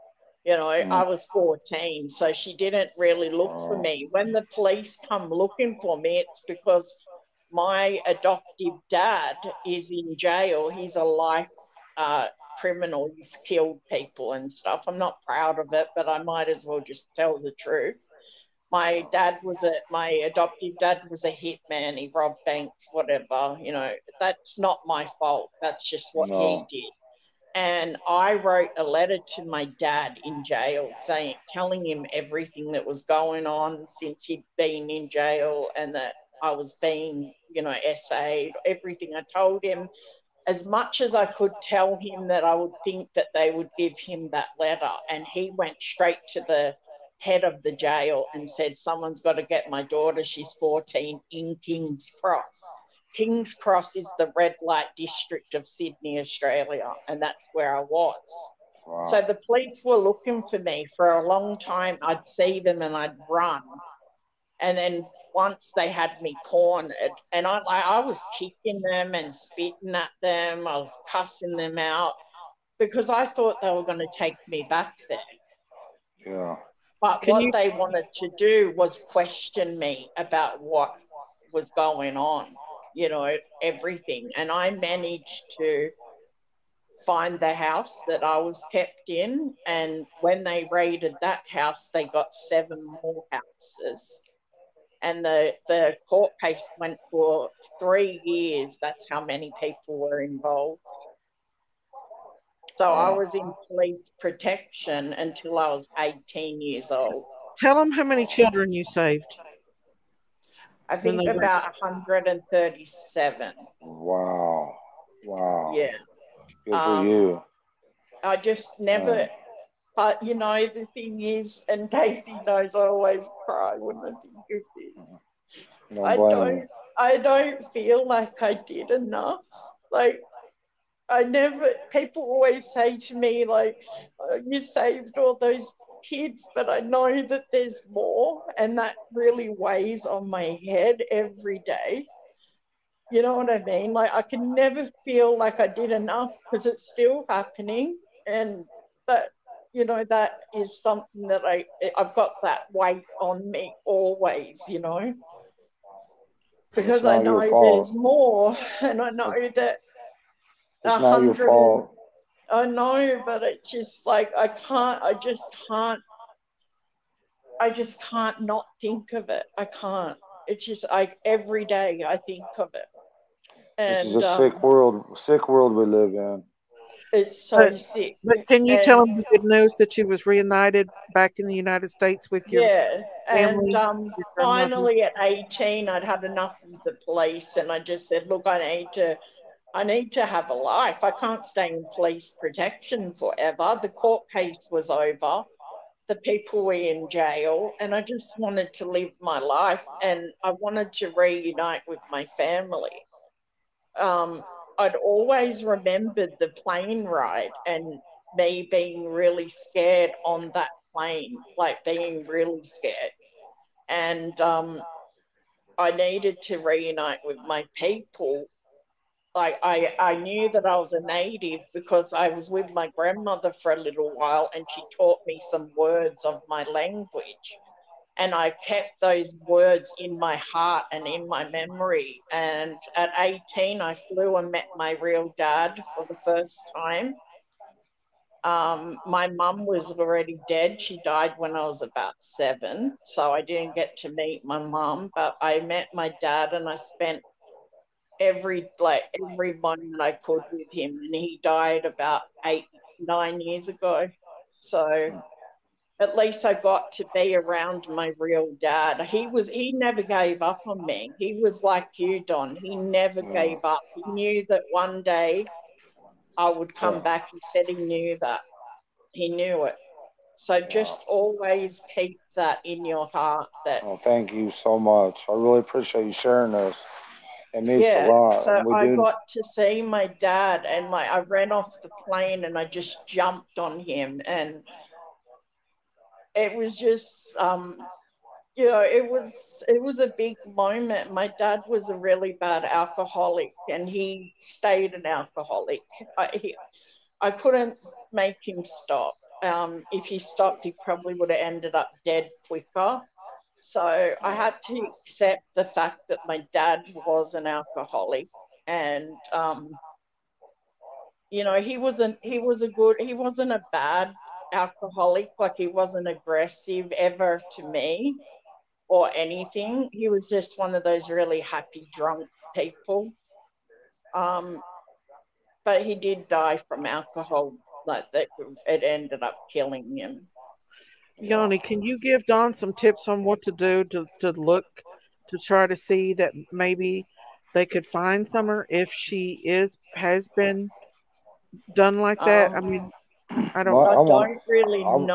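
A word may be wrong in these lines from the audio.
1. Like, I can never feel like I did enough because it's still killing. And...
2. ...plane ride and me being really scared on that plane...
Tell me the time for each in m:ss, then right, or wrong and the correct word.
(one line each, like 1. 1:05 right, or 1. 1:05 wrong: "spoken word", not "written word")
1. 2:23 wrong: "happening", not "killing"
2. 3:26 right.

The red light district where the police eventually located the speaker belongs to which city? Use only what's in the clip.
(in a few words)
Sydney.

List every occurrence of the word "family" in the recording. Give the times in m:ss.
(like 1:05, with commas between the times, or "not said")
3:03, 3:22.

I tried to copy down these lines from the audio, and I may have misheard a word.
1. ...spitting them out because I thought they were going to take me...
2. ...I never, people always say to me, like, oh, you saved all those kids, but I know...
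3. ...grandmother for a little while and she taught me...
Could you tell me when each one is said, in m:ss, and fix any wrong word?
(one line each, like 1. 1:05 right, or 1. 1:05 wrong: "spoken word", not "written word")
1. 1:11 wrong: "cussing", not "spitting"
2. 2:11 right
3. 3:42 right.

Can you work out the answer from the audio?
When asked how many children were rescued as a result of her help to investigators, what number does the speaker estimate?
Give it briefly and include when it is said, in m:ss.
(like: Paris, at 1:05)
137, at 1:51.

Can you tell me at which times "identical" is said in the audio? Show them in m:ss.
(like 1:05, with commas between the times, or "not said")
not said.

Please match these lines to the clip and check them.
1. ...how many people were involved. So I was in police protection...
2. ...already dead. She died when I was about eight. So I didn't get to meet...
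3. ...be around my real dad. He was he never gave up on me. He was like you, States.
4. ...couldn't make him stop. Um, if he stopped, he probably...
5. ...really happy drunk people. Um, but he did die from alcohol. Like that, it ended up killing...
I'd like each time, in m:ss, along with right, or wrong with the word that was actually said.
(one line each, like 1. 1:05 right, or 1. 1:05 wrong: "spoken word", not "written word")
1. 1:39 right
2. 3:59 wrong: "seven", not "eight"
3. 4:17 wrong: "Don", not "States"
4. 4:57 right
5. 5:21 right.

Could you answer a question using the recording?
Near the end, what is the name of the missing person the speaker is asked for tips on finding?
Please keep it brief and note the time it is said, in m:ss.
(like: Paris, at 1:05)
Summer, at 5:38.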